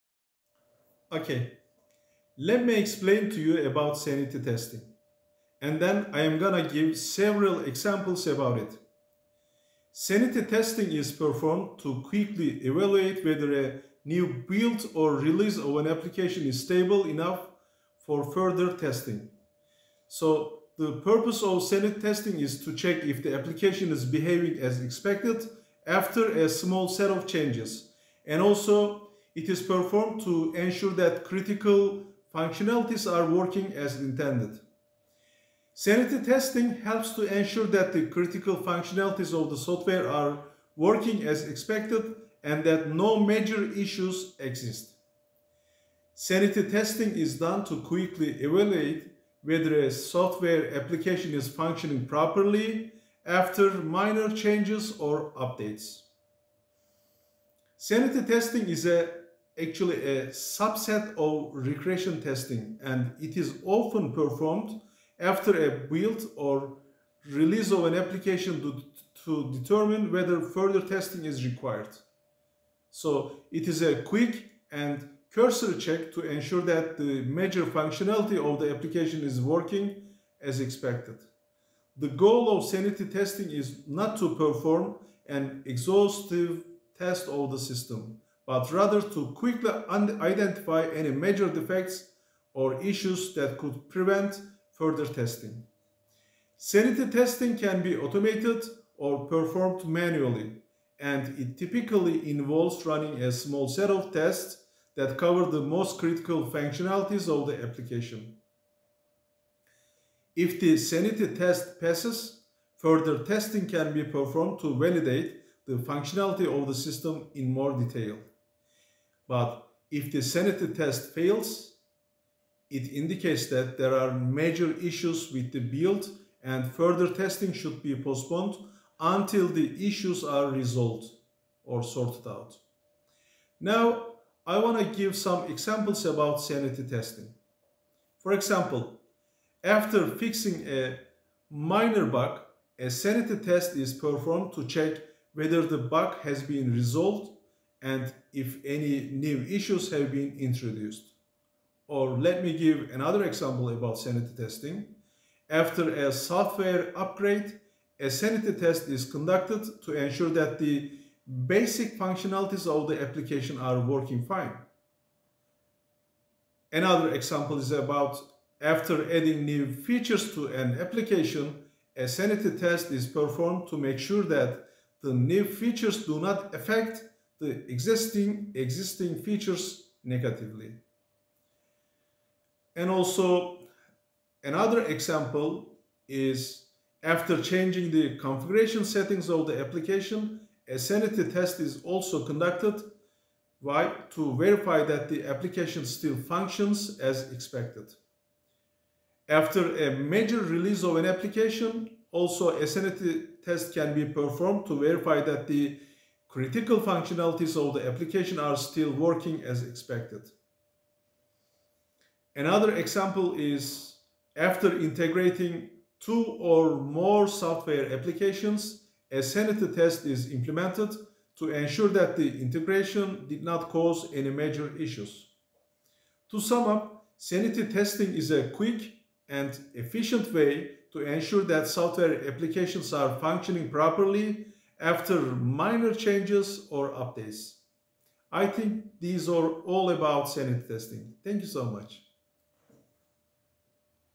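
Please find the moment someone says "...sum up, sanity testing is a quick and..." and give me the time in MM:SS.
03:46.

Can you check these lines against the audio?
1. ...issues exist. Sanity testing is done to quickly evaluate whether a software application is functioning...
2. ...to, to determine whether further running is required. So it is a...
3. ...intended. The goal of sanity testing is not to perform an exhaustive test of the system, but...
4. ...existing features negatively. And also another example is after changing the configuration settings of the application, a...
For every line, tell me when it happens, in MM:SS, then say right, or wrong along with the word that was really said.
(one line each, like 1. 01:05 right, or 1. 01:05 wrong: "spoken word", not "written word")
1. 00:43 right
2. 01:08 wrong: "testing", not "running"
3. 01:20 wrong: "expected", not "intended"
4. 02:58 right.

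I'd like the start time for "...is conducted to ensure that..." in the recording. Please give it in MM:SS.
02:38.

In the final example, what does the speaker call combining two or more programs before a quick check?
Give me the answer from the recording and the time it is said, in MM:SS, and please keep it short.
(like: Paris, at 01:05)
integrating, at 03:34.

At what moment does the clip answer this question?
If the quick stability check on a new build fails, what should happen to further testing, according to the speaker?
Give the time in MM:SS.
02:07.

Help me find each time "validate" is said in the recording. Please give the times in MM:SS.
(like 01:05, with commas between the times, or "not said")
01:54.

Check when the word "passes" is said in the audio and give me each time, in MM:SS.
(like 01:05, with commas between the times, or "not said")
01:51.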